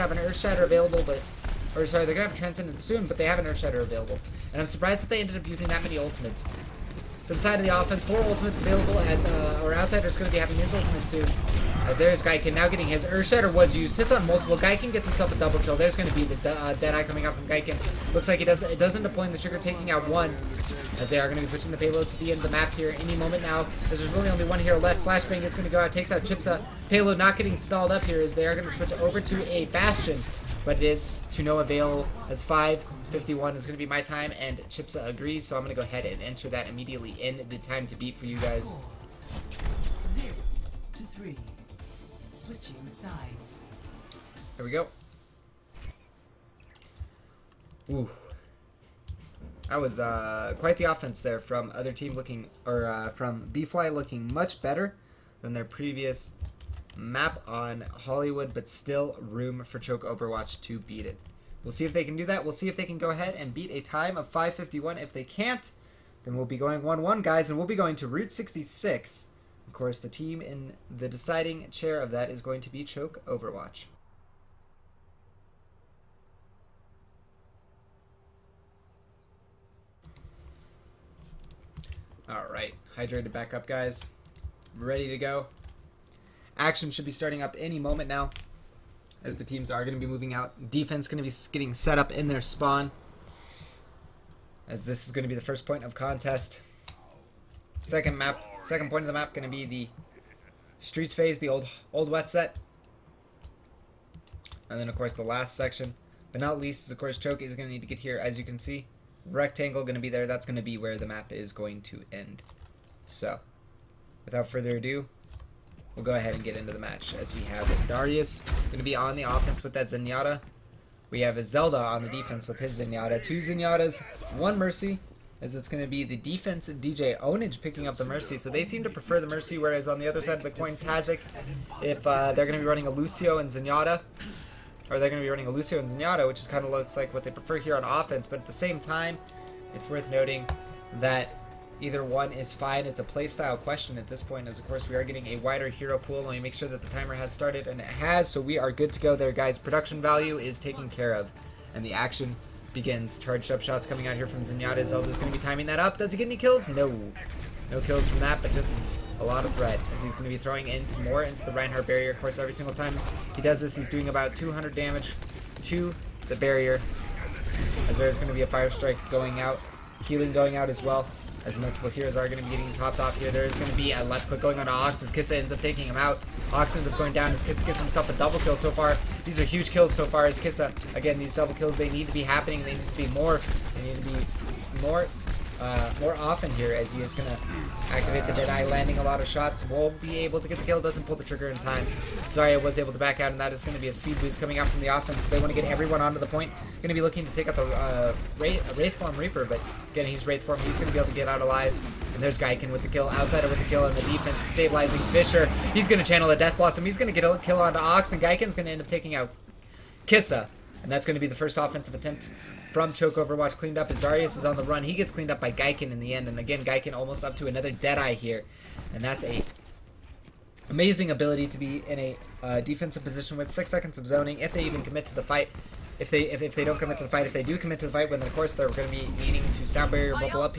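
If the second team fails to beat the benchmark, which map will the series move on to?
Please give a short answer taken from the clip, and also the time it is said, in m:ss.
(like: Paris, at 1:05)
Route 66, at 1:08.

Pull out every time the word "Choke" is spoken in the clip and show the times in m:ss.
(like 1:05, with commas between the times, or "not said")
0:59, 1:12, 1:47, 3:32.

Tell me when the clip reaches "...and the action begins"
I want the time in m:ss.
2:31.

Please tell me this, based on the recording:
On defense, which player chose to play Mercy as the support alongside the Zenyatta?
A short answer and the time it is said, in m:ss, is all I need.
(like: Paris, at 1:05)
DJ Onage, at 2:06.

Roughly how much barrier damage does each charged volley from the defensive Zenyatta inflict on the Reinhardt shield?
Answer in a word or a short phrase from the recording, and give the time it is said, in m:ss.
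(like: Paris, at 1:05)
200, at 2:44.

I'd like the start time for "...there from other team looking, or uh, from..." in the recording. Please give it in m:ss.
0:51.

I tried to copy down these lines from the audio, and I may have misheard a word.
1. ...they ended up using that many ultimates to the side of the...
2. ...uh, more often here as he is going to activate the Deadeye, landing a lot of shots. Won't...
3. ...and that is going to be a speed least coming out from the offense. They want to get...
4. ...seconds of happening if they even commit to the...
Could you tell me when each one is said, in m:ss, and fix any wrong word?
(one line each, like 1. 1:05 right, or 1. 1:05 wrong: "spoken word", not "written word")
1. 0:05 right
2. 3:05 right
3. 3:13 wrong: "boost", not "least"
4. 3:43 wrong: "zoning", not "happening".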